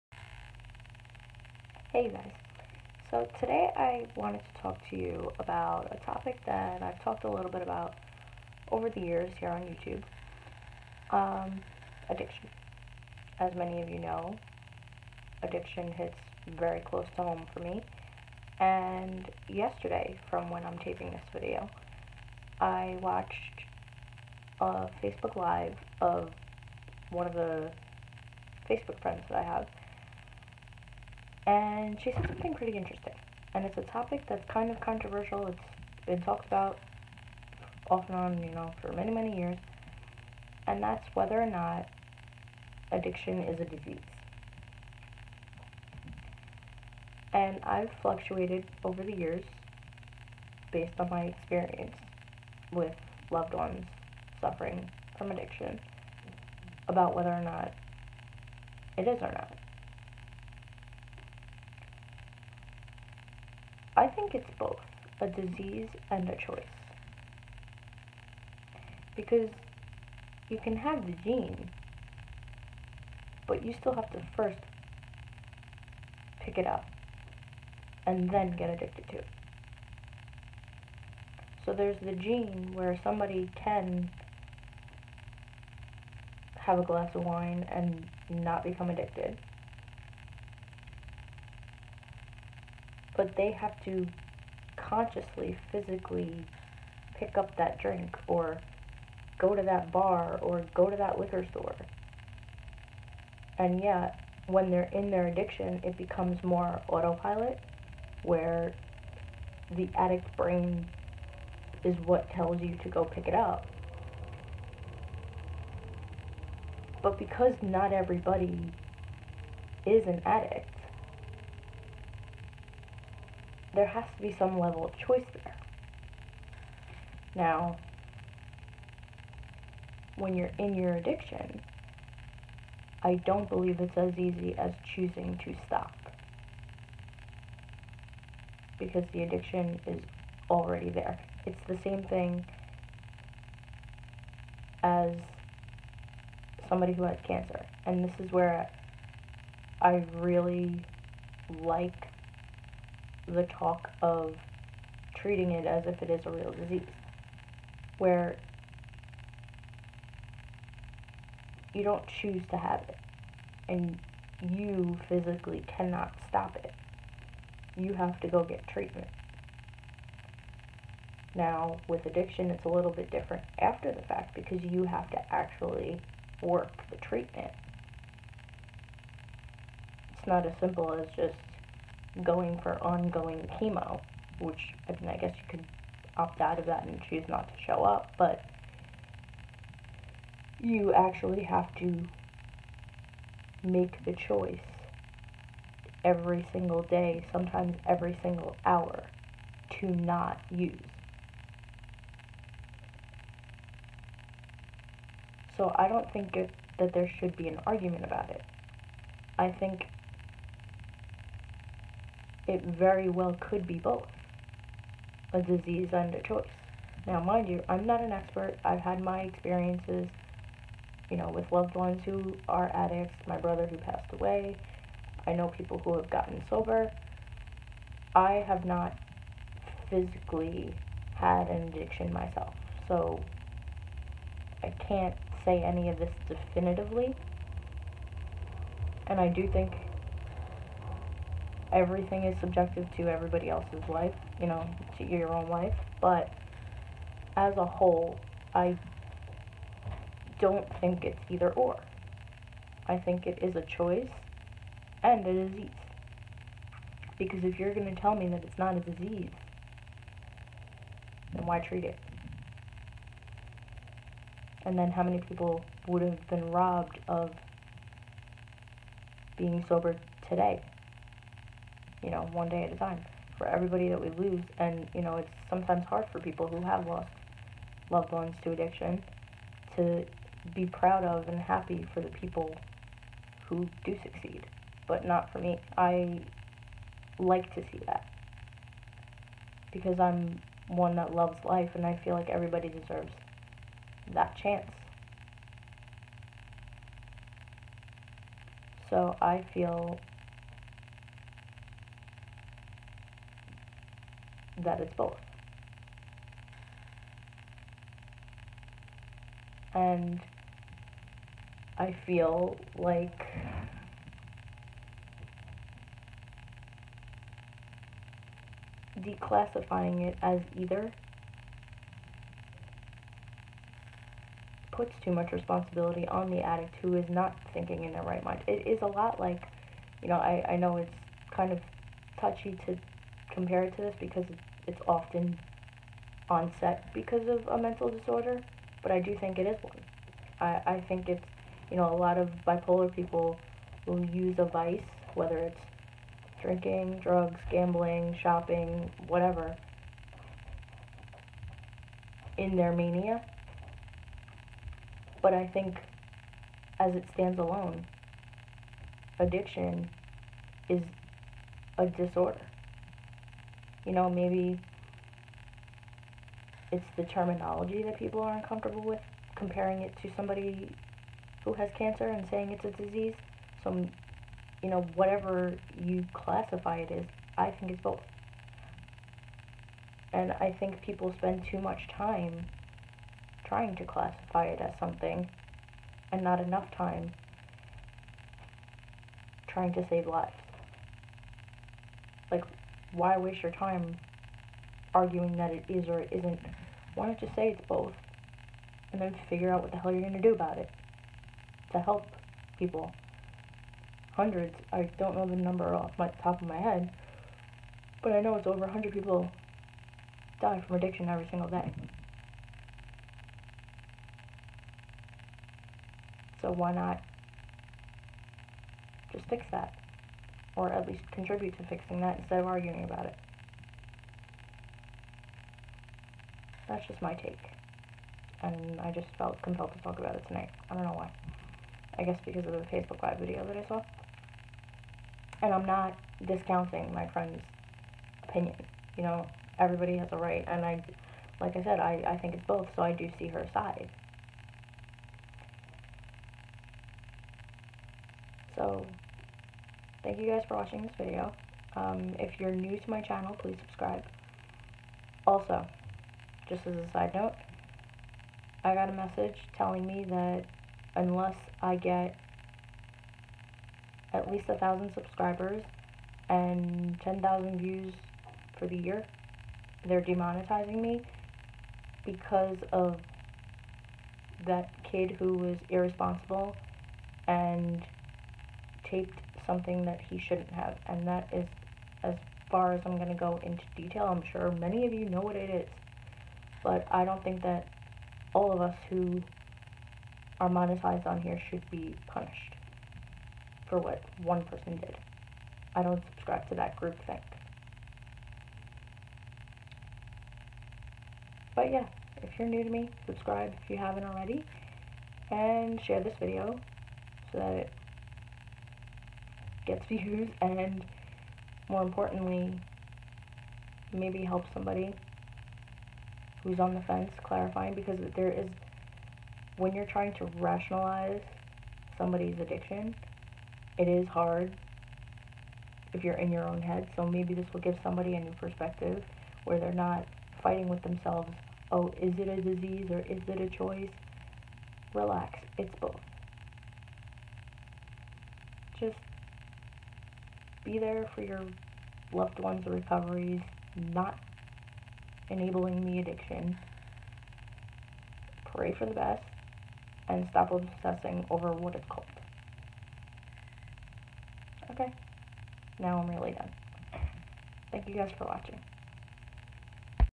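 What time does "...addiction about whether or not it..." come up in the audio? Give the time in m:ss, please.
0:55.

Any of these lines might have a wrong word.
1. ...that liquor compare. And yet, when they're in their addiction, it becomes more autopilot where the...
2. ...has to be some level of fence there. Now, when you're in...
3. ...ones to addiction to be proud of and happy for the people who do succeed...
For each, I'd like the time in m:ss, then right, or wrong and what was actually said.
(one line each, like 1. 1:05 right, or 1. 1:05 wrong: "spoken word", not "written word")
1. 1:40 wrong: "store", not "compare"
2. 2:03 wrong: "choice", not "fence"
3. 4:38 right.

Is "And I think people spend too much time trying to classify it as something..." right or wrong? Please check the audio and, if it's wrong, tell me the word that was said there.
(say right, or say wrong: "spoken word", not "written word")
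right.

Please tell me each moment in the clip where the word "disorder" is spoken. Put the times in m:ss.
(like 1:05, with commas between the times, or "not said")
5:37, 6:01.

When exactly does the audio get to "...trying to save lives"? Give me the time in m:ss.
6:29.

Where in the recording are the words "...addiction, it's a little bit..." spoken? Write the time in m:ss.
2:52.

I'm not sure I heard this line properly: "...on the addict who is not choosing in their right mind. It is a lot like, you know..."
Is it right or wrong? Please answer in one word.
wrong.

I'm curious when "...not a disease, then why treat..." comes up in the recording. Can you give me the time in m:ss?
4:18.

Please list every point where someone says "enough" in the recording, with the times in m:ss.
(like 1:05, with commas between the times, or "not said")
6:26.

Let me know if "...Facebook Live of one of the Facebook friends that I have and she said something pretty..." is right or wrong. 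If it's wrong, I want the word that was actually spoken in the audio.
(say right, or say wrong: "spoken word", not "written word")
right.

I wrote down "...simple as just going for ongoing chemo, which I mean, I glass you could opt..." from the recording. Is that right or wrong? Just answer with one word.
wrong.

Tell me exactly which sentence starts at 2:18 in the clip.
Because the addiction is already there.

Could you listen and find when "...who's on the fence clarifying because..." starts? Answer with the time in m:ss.
8:36.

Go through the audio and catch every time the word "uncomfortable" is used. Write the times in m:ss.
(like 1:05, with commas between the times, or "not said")
6:08.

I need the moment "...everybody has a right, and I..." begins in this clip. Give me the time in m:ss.
7:19.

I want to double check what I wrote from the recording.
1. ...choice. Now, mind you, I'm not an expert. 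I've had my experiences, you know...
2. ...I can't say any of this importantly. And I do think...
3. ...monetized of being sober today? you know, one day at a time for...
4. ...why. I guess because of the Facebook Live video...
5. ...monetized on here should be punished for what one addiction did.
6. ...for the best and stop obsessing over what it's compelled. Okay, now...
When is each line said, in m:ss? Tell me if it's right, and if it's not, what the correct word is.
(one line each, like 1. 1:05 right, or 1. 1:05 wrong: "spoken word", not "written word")
1. 3:36 right
2. 3:54 wrong: "definitively", not "importantly"
3. 4:26 wrong: "robbed", not "monetized"
4. 7:10 right
5. 8:10 wrong: "person", not "addiction"
6. 9:08 wrong: "called", not "compelled".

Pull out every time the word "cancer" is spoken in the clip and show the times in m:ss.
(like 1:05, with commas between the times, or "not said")
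2:27, 6:11.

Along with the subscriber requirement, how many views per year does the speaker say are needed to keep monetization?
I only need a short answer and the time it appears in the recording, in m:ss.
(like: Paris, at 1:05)
10,000, at 7:47.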